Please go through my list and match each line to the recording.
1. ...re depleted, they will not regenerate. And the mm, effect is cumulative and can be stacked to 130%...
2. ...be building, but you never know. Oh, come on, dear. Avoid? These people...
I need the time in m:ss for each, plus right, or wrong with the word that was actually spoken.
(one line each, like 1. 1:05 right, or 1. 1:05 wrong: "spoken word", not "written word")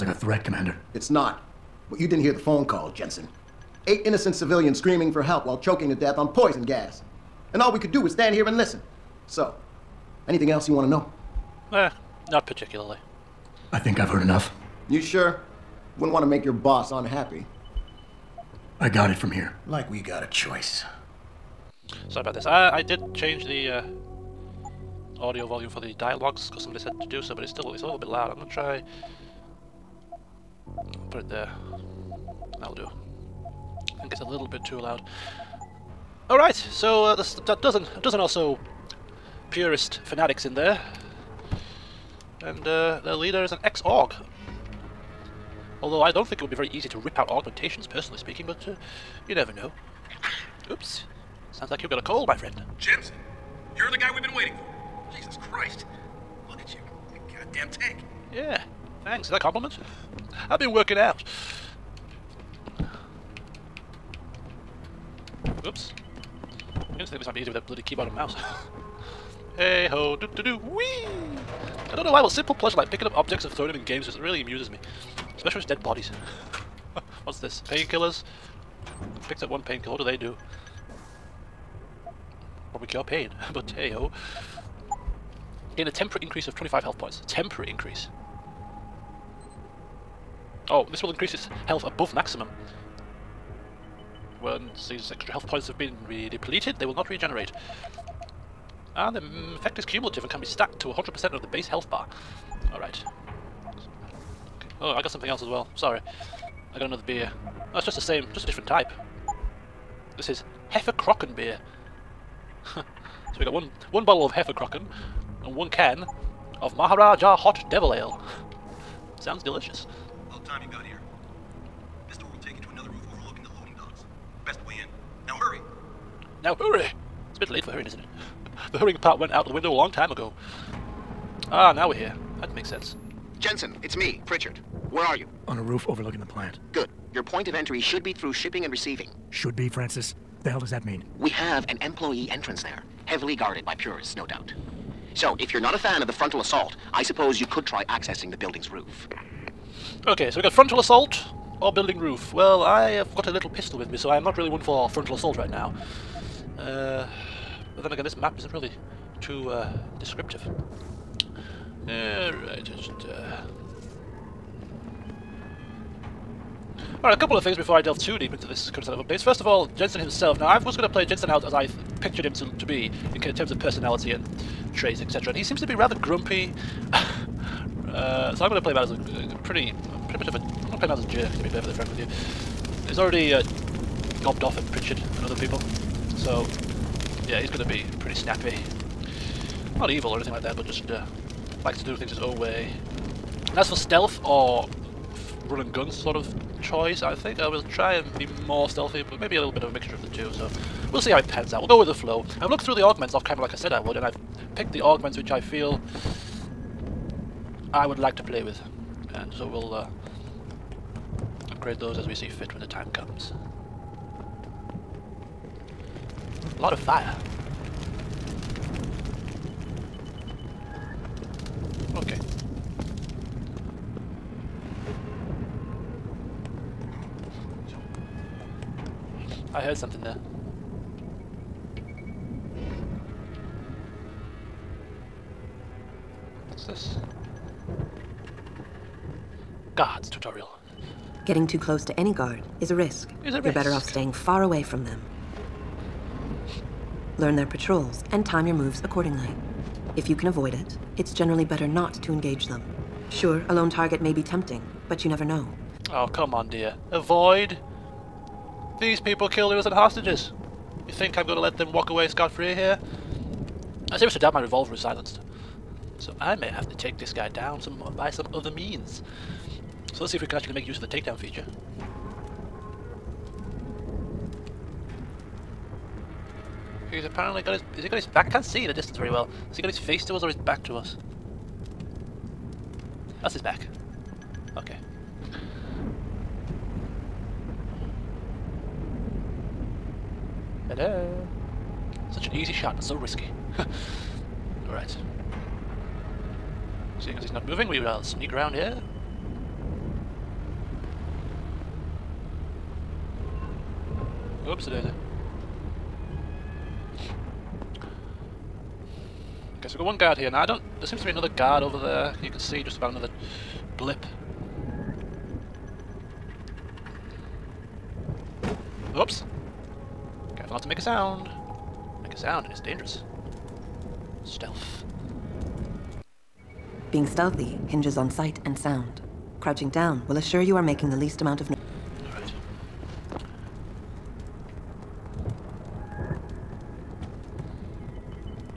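1. 1:36 wrong: "100", not "130"
2. 4:14 wrong: "tempting", not "building".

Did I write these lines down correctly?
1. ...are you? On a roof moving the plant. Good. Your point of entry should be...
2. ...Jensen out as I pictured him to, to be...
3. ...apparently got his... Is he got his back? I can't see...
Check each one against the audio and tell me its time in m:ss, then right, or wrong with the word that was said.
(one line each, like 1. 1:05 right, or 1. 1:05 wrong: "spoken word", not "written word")
1. 2:15 wrong: "overlooking", not "moving"
2. 2:51 right
3. 4:37 right.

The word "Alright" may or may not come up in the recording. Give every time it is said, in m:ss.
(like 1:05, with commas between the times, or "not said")
1:42, 2:47.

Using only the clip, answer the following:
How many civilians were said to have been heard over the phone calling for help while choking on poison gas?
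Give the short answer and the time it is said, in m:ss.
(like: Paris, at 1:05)
8, at 0:03.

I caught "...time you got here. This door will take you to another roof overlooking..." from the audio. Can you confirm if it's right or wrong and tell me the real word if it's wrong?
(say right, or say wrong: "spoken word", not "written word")
right.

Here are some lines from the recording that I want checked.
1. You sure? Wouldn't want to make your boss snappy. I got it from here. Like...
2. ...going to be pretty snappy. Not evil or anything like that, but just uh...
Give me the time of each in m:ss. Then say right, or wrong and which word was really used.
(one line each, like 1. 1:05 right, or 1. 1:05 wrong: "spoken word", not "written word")
1. 0:14 wrong: "unhappy", not "snappy"
2. 3:07 right.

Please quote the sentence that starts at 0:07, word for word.
And all we could do was stand here and listen.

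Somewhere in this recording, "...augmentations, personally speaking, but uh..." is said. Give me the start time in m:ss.
0:47.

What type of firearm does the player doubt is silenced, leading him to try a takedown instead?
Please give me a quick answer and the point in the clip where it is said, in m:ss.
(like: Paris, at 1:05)
revolver, at 4:24.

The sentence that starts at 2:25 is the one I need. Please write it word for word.
So, if you're not a fan of the frontal assault, I suppose you could try accessing the building's roof.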